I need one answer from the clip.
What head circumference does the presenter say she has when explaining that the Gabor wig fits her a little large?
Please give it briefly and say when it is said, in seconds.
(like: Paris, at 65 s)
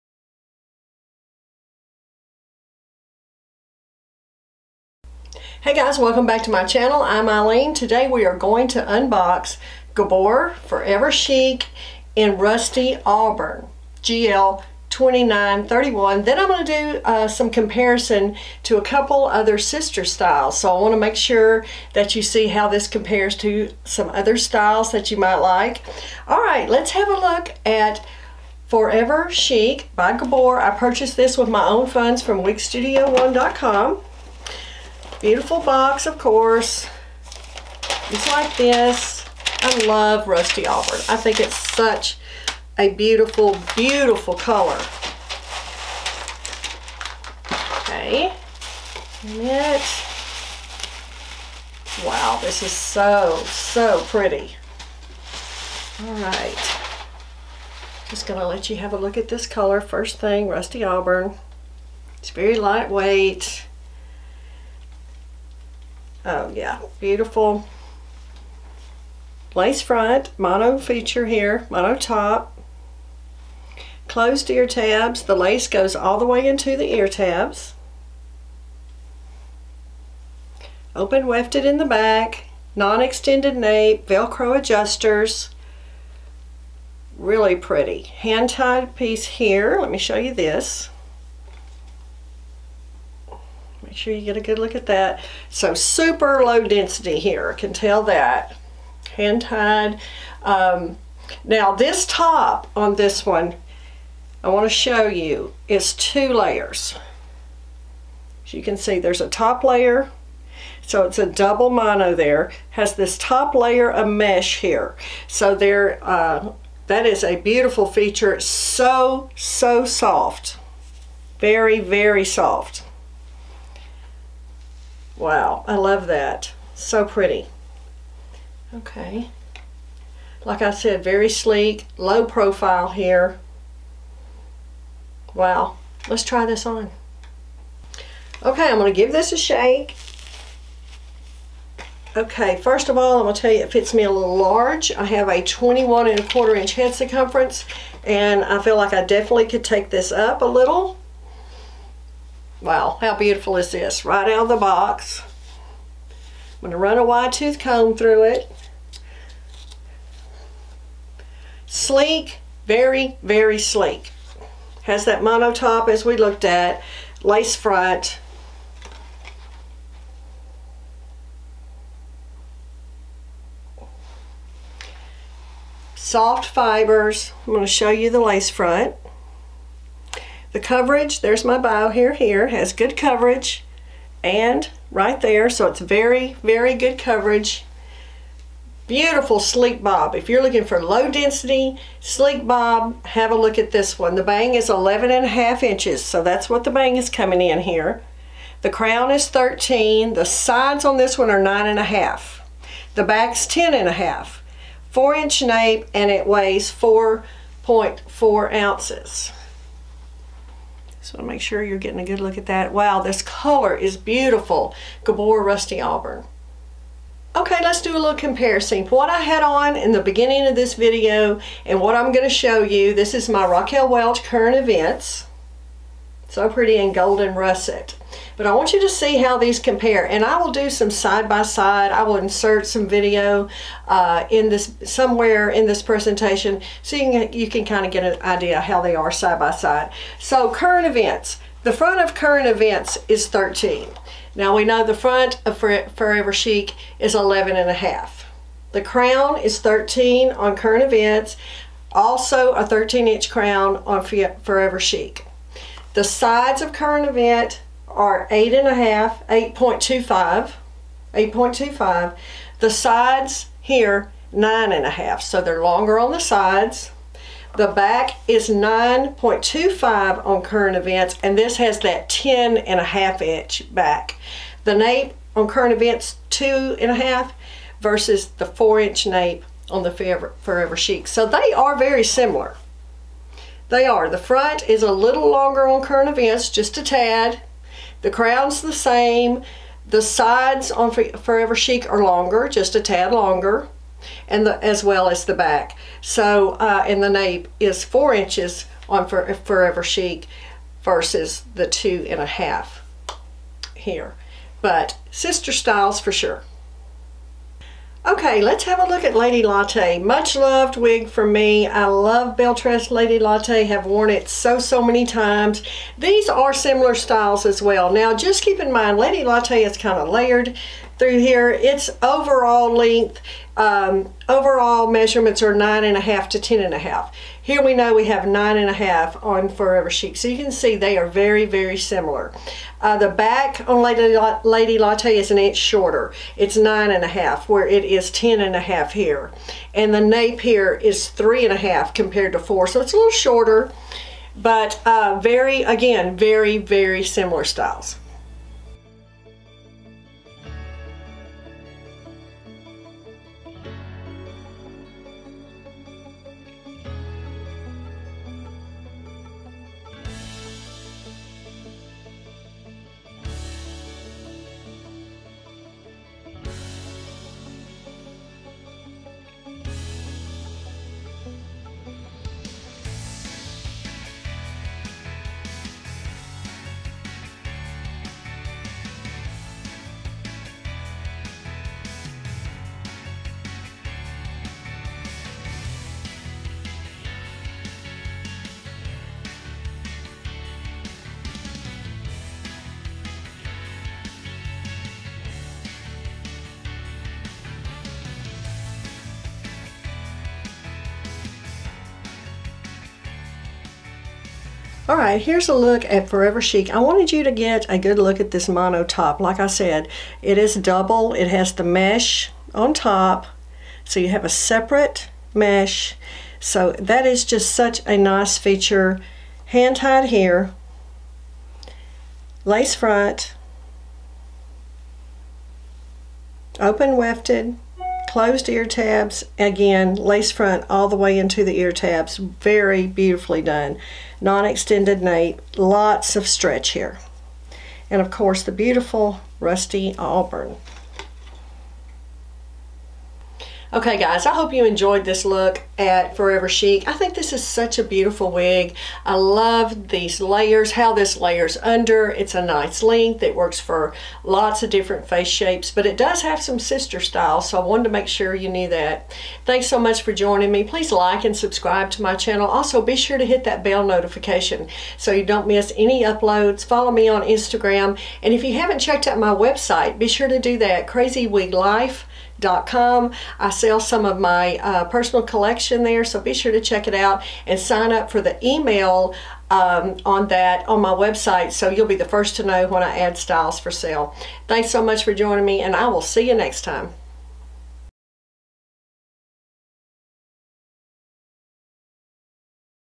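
21 1/4 inches, at 145 s.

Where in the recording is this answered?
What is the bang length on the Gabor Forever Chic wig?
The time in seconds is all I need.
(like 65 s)
194 s.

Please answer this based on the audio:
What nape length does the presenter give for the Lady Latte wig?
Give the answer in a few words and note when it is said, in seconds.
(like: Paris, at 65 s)
3.5 inches, at 341 s.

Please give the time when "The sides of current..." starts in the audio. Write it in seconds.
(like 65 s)
255 s.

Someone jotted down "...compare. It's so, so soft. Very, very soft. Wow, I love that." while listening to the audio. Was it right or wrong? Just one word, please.
wrong.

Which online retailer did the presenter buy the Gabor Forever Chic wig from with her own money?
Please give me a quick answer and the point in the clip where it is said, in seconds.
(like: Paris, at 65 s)
wigstudio1.com, at 32 s.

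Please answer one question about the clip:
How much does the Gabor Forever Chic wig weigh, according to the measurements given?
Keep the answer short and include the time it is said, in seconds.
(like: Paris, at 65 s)
4.4 ounces, at 206 s.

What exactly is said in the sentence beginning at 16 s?
Then I'm going to do uh, some comparison to a couple other sister styles.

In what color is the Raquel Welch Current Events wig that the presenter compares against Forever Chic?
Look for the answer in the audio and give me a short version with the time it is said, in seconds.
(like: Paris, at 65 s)
Golden russet, at 226 s.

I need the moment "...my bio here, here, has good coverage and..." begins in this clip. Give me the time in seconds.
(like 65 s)
181 s.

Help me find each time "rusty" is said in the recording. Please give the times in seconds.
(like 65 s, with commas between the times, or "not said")
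12 s, 40 s, 60 s, 215 s, 439 s.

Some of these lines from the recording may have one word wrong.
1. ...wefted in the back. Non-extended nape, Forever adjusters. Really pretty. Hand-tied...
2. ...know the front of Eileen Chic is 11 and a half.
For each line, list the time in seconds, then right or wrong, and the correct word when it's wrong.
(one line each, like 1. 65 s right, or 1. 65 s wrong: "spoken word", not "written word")
1. 81 s wrong: "Velcro", not "Forever"
2. 244 s wrong: "Forever", not "Eileen".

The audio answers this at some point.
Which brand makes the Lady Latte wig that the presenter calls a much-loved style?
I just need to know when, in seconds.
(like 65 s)
312 s.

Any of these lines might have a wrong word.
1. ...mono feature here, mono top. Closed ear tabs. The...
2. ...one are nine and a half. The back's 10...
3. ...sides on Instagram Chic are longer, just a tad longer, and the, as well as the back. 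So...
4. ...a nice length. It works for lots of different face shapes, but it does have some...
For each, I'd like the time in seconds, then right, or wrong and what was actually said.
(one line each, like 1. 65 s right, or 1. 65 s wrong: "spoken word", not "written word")
1. 70 s right
2. 201 s right
3. 290 s wrong: "Forever", not "Instagram"
4. 452 s right.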